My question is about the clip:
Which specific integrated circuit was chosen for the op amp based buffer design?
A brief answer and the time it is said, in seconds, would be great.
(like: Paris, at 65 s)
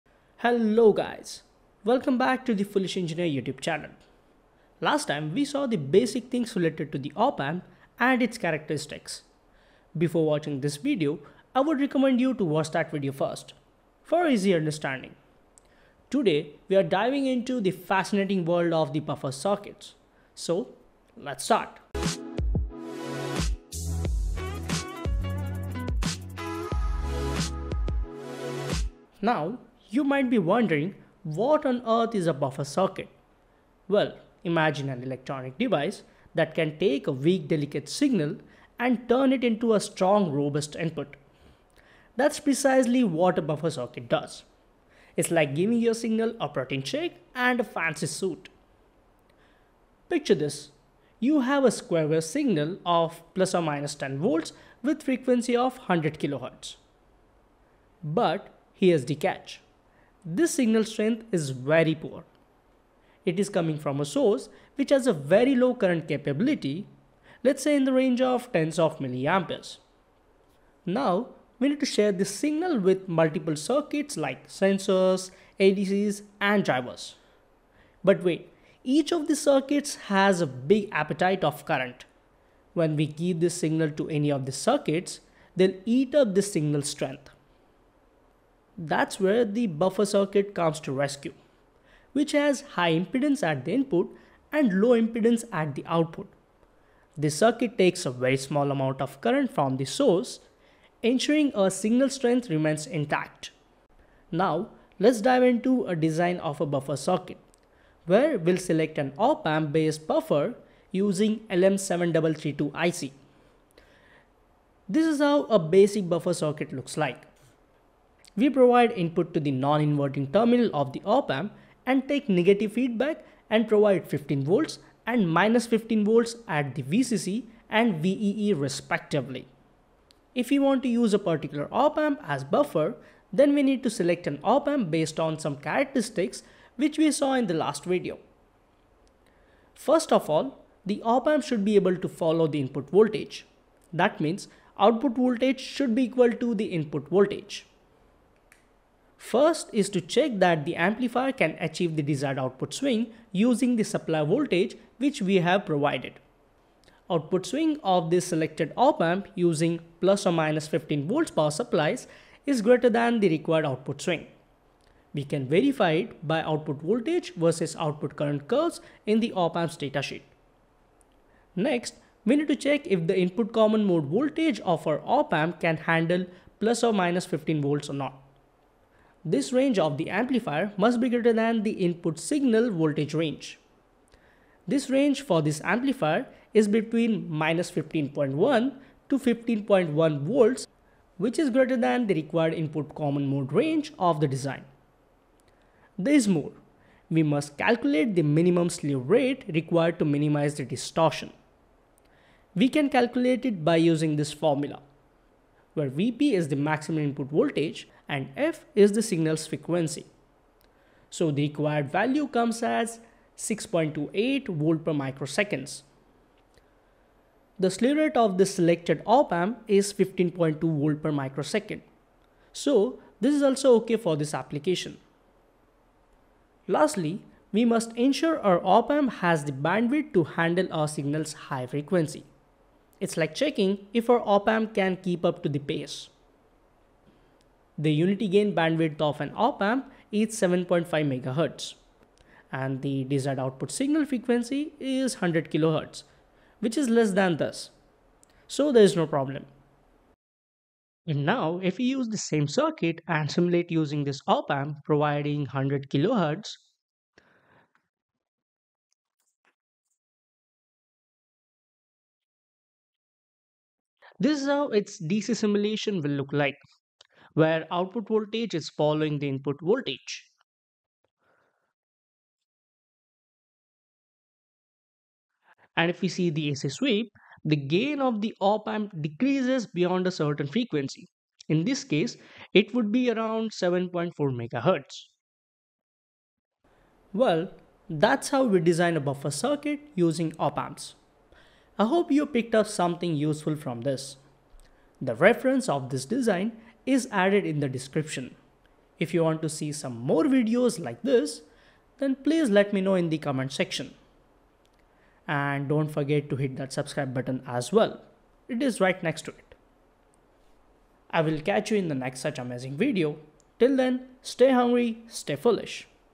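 LM7332, at 111 s.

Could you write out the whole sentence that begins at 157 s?
Output swing of this selected op amp using plus or minus 15 volts power supplies is greater than the required output swing.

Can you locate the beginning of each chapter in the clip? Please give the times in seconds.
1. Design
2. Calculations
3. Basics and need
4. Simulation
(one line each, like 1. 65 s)
1. 104 s
2. 141 s
3. 30 s
4. 250 s.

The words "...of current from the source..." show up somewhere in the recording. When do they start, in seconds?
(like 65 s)
99 s.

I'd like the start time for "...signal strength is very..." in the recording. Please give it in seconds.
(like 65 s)
60 s.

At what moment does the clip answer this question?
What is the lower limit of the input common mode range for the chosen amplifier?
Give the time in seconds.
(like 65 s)
187 s.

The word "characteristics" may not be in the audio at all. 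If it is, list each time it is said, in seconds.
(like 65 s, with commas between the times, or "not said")
8 s, 135 s.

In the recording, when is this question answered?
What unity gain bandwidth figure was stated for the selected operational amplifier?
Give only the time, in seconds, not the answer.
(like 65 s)
240 s.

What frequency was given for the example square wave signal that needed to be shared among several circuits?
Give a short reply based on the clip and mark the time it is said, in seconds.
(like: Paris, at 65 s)
100 kHz, at 55 s.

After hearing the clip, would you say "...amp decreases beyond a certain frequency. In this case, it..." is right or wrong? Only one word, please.
right.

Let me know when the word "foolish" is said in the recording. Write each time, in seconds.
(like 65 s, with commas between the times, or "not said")
2 s, 315 s.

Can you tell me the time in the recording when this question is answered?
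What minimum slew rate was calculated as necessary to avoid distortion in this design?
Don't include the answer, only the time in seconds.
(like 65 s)
213 s.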